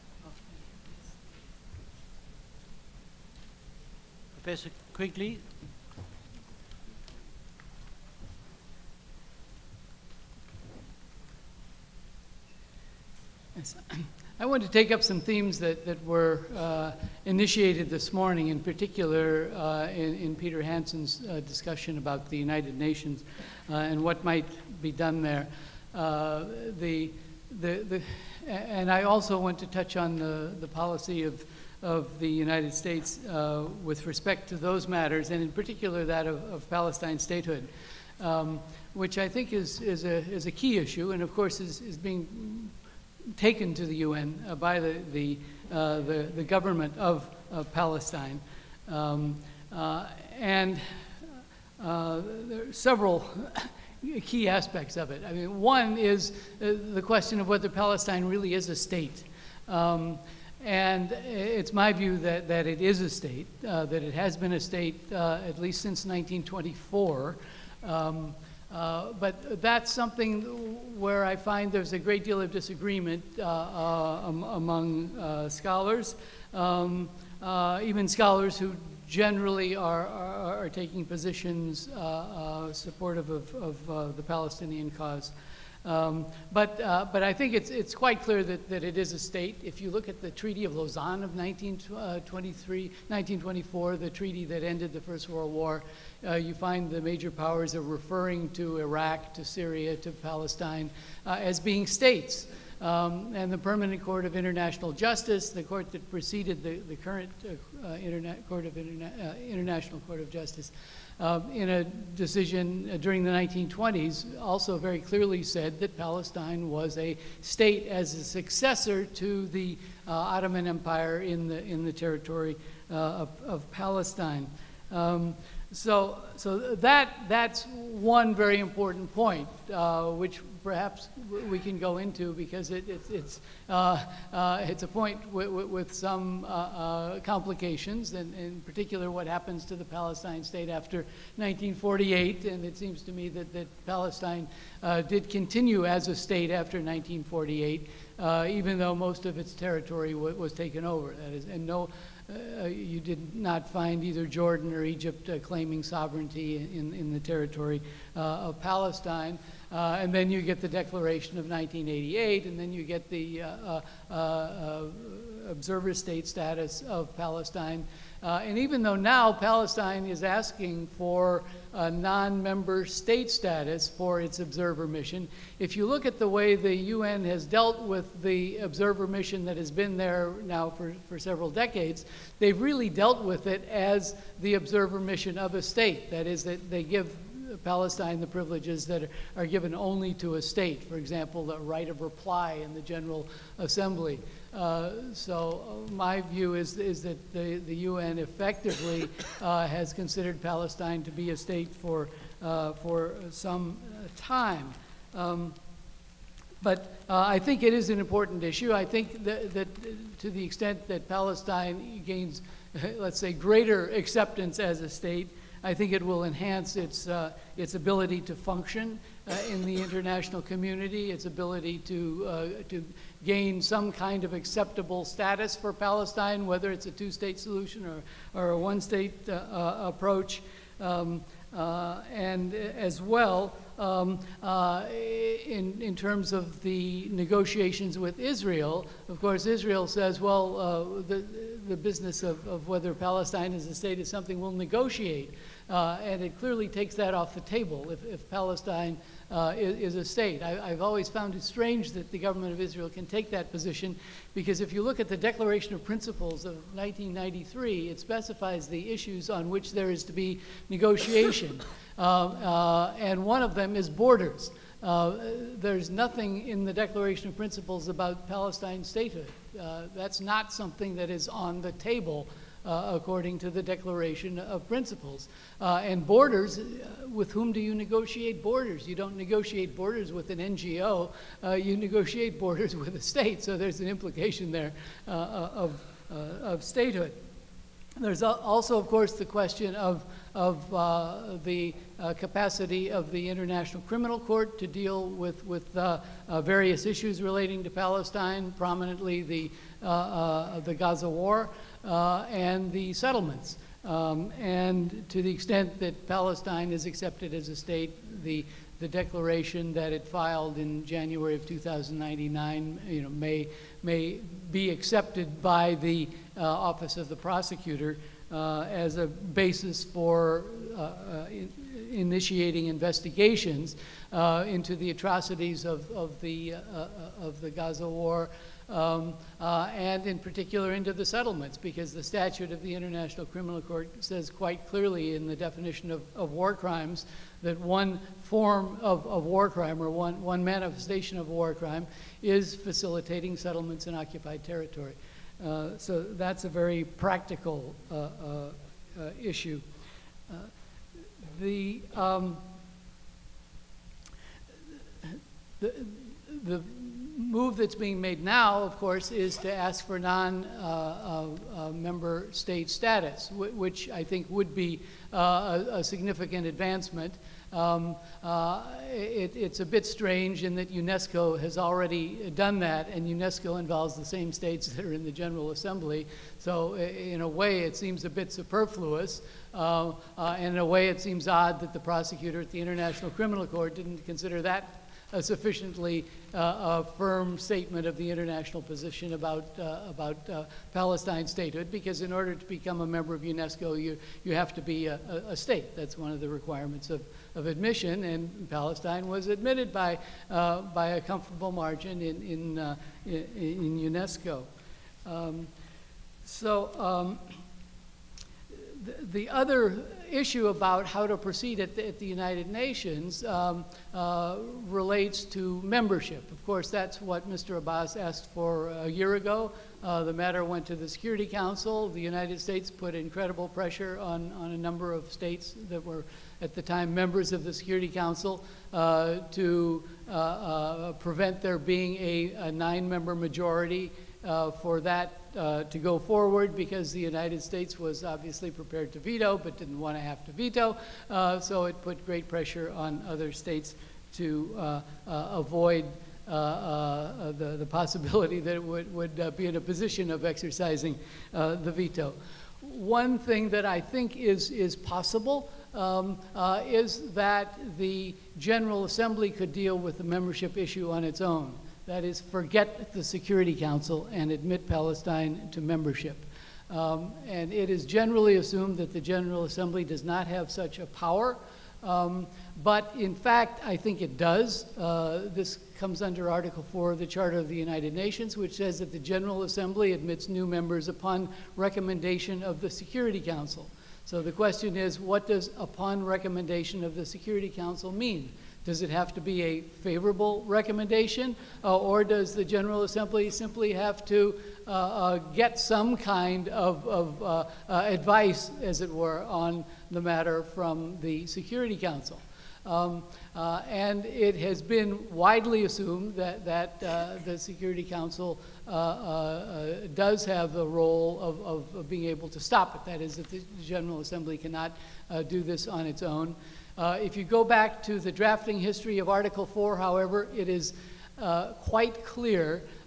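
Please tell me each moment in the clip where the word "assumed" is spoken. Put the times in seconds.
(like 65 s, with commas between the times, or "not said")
468 s, 505 s.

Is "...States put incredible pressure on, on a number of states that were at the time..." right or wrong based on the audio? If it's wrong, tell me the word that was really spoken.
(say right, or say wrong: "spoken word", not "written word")
right.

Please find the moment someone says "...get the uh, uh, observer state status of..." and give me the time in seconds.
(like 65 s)
162 s.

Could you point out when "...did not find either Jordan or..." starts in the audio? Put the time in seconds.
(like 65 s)
152 s.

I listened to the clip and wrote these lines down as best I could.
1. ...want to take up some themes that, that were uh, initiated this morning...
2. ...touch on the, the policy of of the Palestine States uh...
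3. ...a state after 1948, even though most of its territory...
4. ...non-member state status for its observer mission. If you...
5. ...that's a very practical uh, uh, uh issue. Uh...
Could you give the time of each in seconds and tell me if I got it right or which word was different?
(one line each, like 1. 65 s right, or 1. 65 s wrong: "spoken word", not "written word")
1. 14 s right
2. 29 s wrong: "United", not "Palestine"
3. 146 s right
4. 171 s right
5. 346 s right.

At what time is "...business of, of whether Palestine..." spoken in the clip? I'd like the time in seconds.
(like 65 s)
241 s.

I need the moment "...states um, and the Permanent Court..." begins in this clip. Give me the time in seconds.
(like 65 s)
101 s.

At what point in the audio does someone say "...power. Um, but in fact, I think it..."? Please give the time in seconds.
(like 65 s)
470 s.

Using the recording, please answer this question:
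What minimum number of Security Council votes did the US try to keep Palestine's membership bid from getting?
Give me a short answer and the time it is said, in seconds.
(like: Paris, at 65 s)
9, at 432 s.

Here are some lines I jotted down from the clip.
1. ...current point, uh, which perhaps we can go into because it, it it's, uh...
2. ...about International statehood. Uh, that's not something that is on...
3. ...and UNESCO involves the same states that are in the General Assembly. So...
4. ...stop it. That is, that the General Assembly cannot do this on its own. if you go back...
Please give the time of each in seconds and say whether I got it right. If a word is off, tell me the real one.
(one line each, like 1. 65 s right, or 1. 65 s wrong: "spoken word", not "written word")
1. 128 s wrong: "important", not "current"
2. 267 s wrong: "Palestine", not "International"
3. 372 s right
4. 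512 s right.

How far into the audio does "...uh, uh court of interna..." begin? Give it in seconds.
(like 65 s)
107 s.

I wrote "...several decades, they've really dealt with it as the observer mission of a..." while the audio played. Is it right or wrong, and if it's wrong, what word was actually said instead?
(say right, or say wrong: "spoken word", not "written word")
right.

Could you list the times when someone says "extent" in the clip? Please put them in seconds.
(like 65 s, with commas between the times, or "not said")
210 s, 305 s.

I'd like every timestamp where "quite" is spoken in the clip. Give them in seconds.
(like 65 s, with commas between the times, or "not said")
87 s, 334 s, 521 s.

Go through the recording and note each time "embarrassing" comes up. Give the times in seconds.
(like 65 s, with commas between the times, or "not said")
not said.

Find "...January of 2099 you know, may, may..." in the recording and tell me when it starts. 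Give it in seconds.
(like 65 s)
310 s.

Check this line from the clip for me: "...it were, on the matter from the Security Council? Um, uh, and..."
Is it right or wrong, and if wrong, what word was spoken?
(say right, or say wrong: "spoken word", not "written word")
right.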